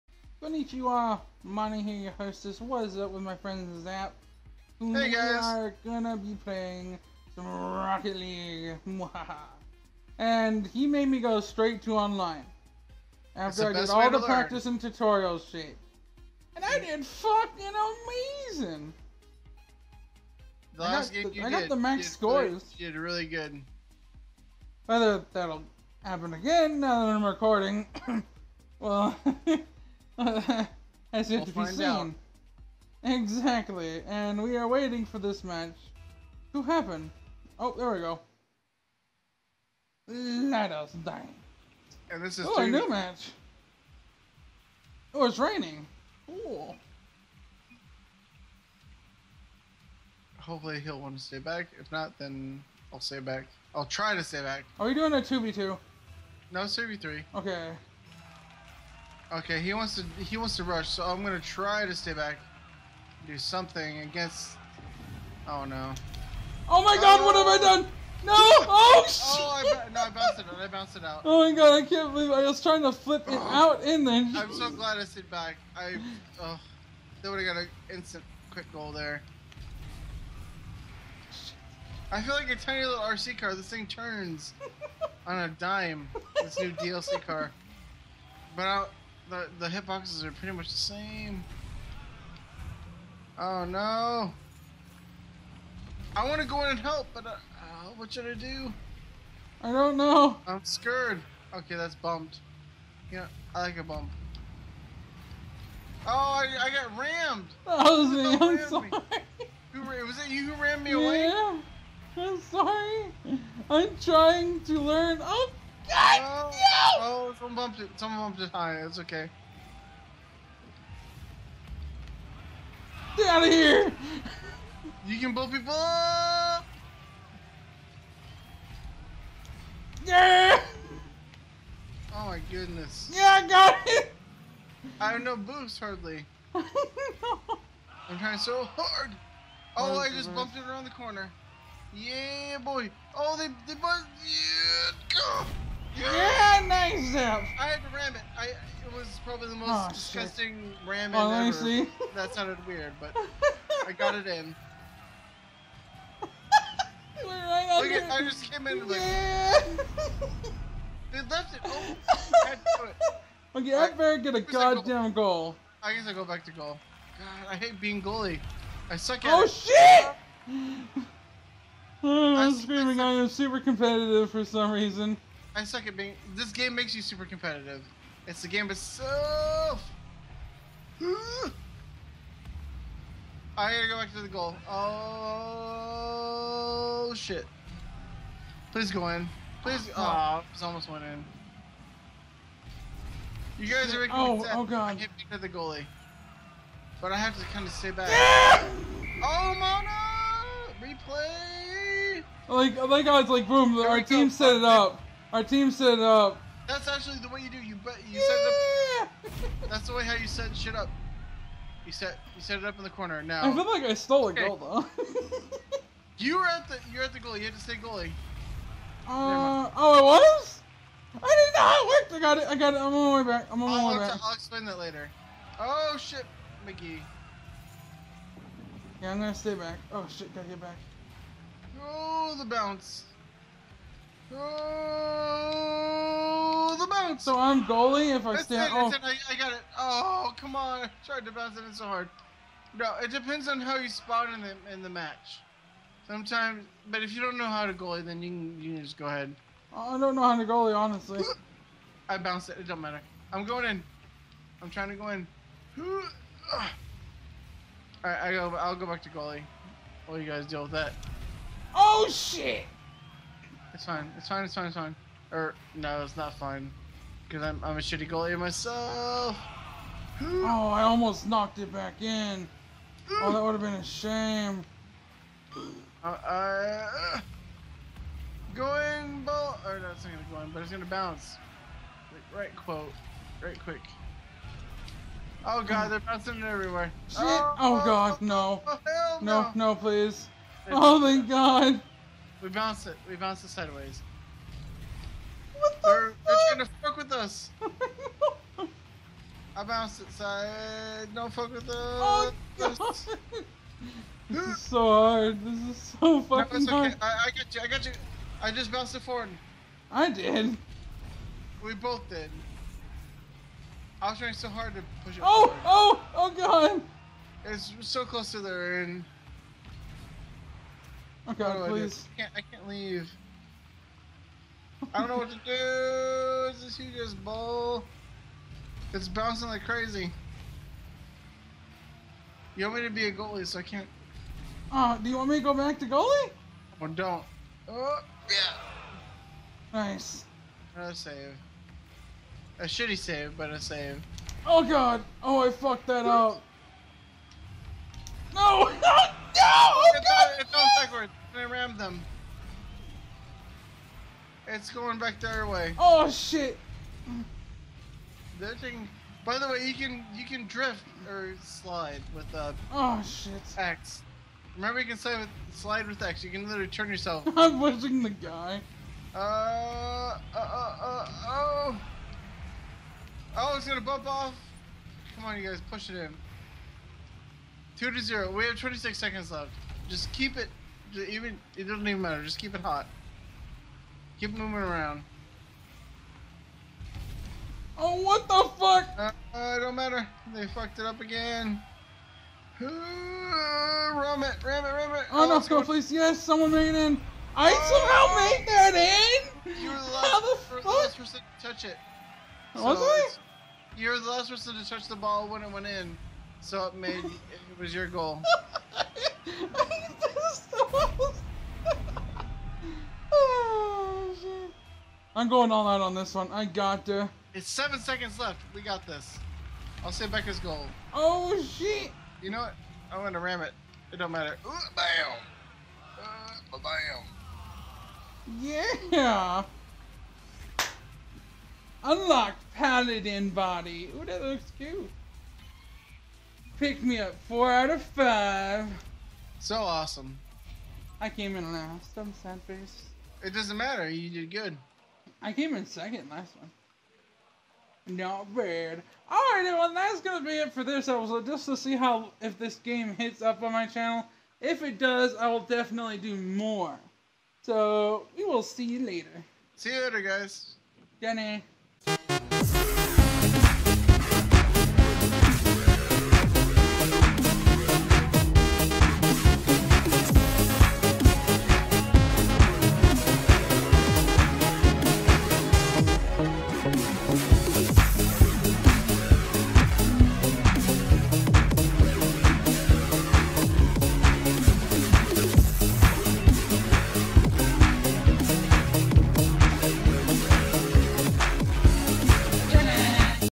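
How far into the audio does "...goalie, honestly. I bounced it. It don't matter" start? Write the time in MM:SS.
04:10.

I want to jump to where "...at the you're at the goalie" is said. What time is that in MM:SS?
03:36.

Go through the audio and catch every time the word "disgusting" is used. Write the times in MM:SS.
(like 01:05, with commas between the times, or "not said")
02:29.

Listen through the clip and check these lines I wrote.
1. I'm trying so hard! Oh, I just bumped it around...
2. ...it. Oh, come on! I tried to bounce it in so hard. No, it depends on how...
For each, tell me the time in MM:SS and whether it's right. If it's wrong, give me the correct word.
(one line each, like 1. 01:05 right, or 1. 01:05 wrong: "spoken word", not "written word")
1. 02:18 right
2. 03:59 right.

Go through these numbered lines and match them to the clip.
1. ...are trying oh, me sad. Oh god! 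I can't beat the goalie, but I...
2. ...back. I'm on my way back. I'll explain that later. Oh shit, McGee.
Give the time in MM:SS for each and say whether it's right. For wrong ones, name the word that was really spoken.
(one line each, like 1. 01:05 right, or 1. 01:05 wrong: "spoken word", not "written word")
1. 03:13 wrong: "making", not "trying"
2. 03:43 right.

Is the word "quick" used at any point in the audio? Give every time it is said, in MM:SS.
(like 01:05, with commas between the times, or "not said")
01:18, 04:43.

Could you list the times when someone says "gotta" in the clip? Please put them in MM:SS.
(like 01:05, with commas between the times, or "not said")
03:03, 03:50.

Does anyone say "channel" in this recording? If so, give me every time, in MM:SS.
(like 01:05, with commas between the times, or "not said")
07:33.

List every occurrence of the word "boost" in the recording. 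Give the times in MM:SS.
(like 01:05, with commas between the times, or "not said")
02:15.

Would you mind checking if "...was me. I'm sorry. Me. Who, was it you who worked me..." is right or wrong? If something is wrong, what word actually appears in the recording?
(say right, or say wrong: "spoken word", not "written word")
wrong: "rammed", not "worked".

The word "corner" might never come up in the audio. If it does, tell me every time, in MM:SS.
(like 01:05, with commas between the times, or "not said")
02:20, 03:32.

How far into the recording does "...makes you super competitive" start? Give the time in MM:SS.
02:56.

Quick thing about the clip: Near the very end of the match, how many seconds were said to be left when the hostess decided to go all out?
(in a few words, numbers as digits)
7.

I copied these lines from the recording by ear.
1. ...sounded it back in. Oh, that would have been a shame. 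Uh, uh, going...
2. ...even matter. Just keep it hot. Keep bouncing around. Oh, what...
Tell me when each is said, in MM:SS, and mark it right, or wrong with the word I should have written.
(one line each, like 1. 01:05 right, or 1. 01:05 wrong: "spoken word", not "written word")
1. 04:31 wrong: "knocked", not "sounded"
2. 06:21 wrong: "moving", not "bouncing".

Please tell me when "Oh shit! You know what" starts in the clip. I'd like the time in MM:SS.
07:00.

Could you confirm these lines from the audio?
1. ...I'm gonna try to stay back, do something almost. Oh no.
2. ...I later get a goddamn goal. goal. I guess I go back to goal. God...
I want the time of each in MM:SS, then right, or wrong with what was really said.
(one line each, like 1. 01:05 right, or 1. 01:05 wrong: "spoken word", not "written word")
1. 01:01 wrong: "against", not "almost"
2. 02:43 wrong: "better", not "later".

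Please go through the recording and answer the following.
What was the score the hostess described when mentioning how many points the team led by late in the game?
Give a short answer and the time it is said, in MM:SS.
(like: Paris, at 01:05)
Two to zero, at 06:17.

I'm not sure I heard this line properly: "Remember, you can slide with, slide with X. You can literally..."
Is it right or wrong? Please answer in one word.
right.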